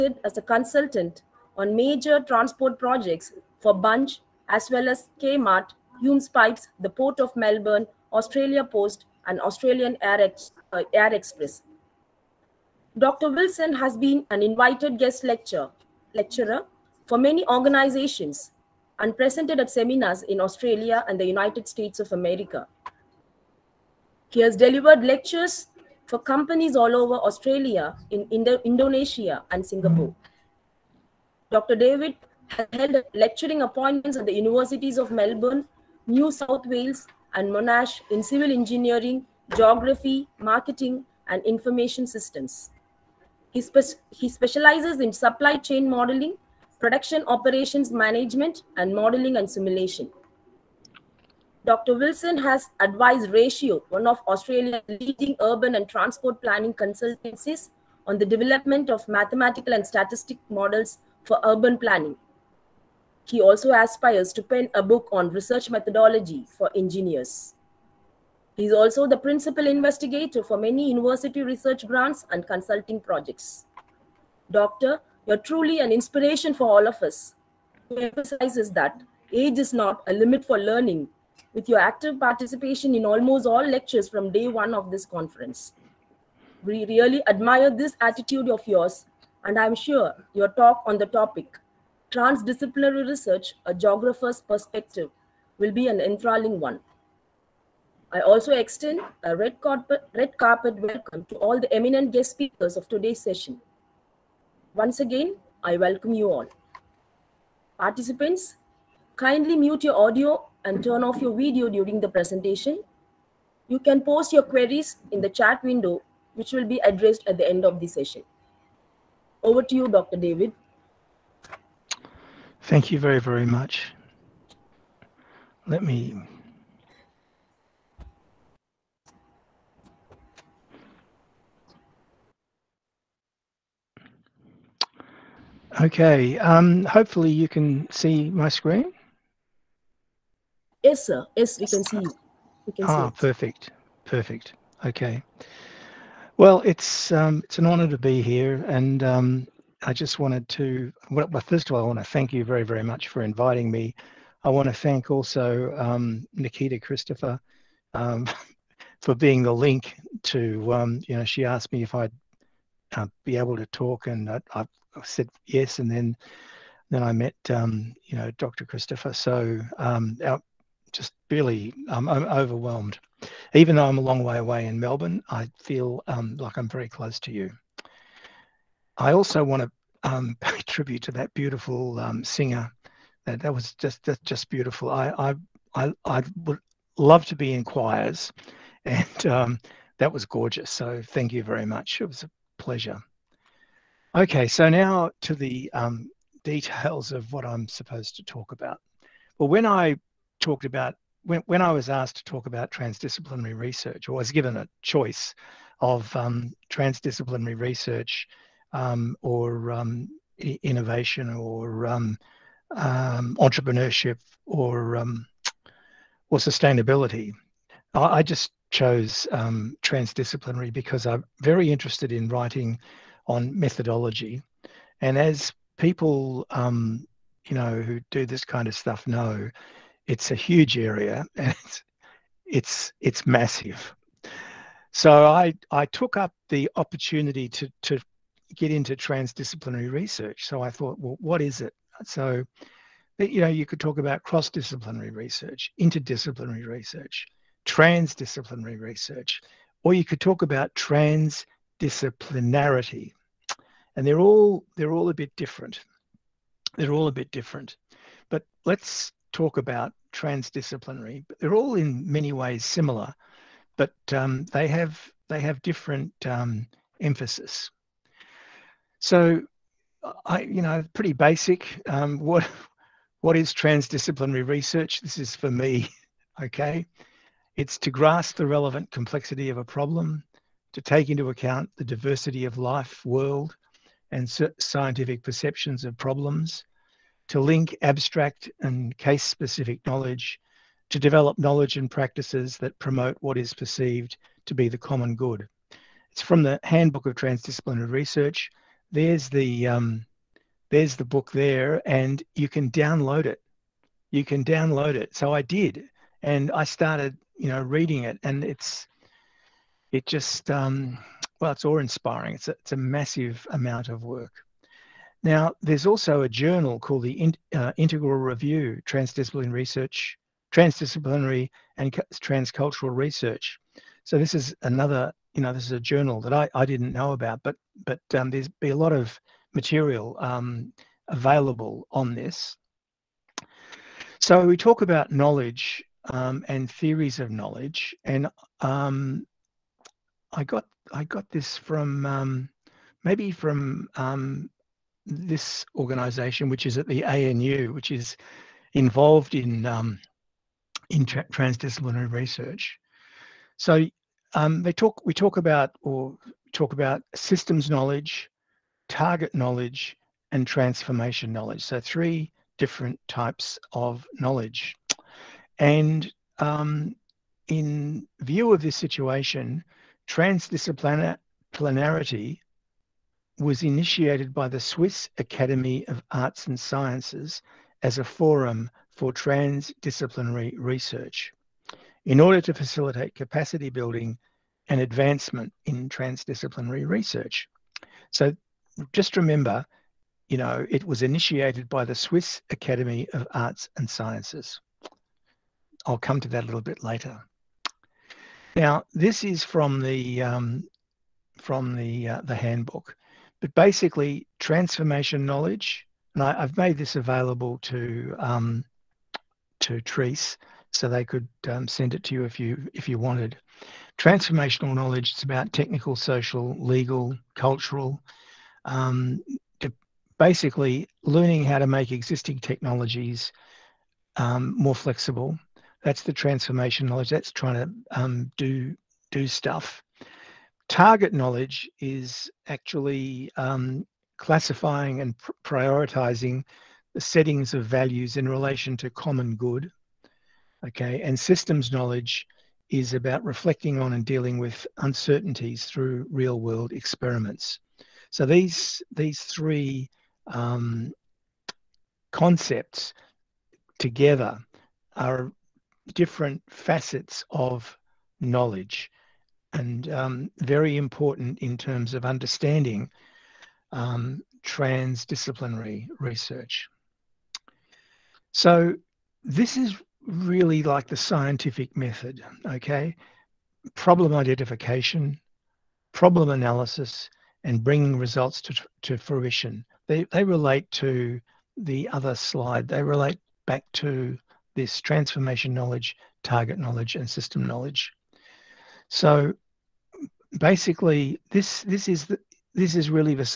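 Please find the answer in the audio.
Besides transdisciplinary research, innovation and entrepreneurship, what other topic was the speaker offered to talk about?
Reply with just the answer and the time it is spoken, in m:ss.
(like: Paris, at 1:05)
Sustainability, at 3:36.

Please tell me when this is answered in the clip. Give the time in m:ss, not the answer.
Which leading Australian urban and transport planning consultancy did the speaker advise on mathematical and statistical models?
0:53.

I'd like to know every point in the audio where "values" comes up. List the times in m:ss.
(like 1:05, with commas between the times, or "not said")
7:17.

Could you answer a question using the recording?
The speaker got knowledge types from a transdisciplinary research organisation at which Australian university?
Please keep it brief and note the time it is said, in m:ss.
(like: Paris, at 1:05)
ANU, at 5:47.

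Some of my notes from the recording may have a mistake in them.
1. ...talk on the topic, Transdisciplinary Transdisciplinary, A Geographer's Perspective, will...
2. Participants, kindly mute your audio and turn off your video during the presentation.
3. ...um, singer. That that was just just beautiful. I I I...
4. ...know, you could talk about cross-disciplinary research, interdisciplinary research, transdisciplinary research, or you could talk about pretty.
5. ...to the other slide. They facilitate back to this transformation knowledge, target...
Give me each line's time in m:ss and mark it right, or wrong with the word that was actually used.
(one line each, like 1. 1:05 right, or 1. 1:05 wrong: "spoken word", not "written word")
1. 1:30 wrong: "Research", not "Transdisciplinary"
2. 1:47 right
3. 3:01 right
4. 4:03 wrong: "transdisciplinarity", not "pretty"
5. 8:00 wrong: "relate", not "facilitate".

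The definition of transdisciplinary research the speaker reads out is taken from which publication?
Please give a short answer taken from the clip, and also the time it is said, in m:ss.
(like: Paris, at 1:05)
Handbook of Transdisciplinary Research, at 4:56.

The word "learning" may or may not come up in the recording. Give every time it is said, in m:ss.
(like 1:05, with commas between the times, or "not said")
1:20, 7:01.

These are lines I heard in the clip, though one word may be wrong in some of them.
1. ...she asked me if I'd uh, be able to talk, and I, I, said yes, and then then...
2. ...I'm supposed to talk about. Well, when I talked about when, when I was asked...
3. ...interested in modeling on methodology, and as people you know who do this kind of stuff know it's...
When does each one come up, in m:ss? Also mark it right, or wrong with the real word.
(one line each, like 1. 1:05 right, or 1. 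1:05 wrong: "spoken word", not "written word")
1. 2:41 right
2. 3:17 right
3. 3:41 wrong: "writing", not "modeling".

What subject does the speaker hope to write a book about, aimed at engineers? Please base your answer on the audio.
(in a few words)
Research methodology.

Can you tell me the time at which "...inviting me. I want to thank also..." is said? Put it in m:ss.
2:33.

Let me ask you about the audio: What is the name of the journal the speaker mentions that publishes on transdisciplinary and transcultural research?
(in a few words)
Integral Review.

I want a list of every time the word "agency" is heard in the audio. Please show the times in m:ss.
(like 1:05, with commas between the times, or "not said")
not said.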